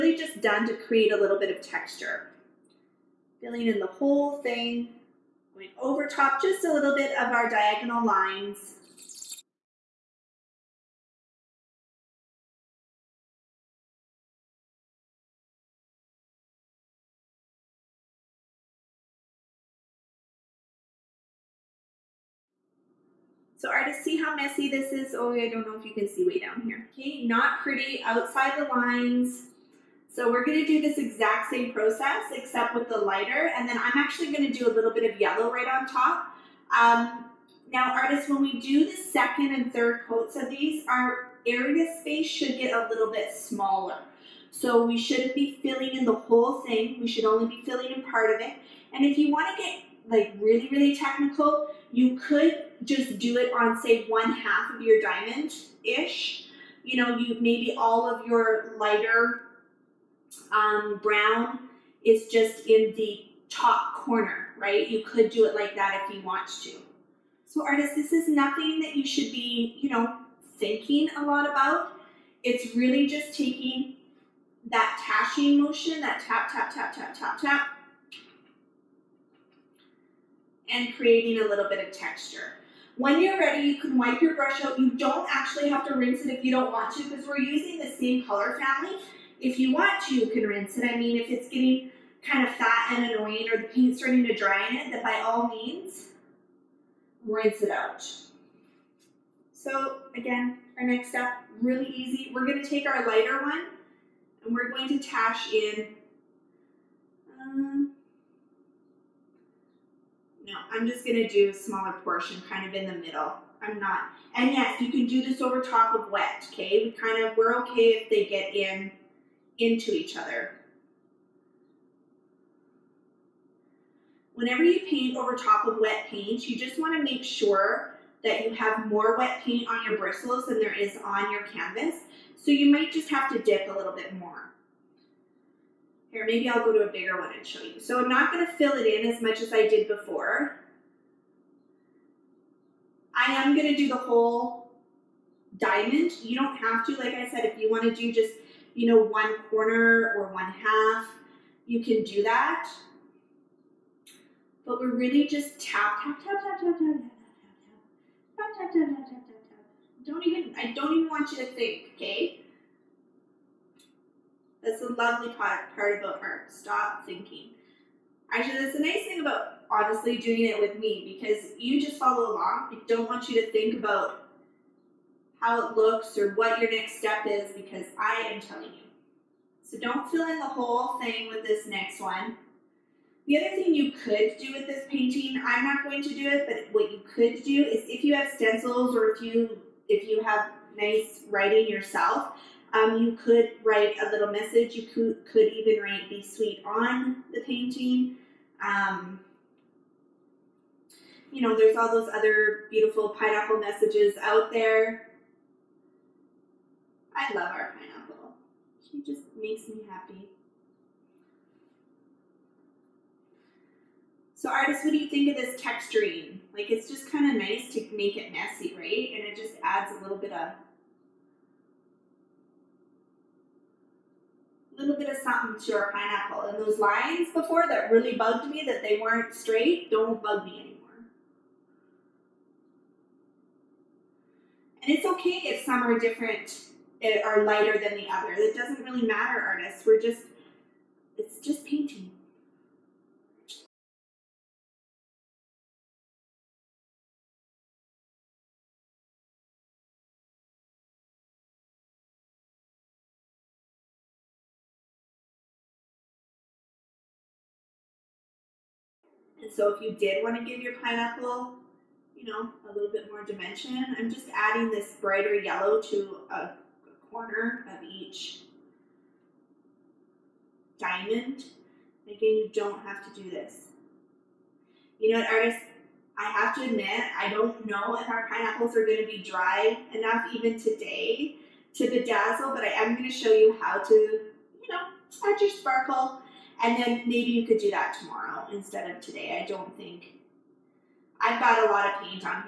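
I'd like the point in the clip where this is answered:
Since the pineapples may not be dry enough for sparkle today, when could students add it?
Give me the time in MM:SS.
04:47.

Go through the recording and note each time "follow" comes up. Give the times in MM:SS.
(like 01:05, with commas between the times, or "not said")
02:51.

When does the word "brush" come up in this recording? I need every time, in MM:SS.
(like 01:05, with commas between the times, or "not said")
01:24.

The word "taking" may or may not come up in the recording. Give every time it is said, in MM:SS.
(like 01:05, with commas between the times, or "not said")
01:13.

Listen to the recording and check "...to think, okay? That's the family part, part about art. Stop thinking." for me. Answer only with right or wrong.
wrong.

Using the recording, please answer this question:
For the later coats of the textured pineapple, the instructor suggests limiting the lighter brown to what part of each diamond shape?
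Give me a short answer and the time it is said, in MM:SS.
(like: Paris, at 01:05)
the top corner, at 01:03.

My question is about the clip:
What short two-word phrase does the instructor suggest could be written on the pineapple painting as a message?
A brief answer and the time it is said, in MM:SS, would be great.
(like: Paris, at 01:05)
Be sweet, at 03:16.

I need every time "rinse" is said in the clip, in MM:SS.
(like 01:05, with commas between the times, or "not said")
01:25, 01:30, 01:37.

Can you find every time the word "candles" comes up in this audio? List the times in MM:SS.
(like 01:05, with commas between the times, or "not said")
not said.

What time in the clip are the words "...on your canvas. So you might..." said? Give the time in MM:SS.
02:11.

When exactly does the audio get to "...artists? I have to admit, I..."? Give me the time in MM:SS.
04:35.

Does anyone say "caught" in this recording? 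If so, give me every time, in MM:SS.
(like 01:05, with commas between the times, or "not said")
not said.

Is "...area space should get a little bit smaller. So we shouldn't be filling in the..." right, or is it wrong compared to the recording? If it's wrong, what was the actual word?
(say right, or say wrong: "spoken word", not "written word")
right.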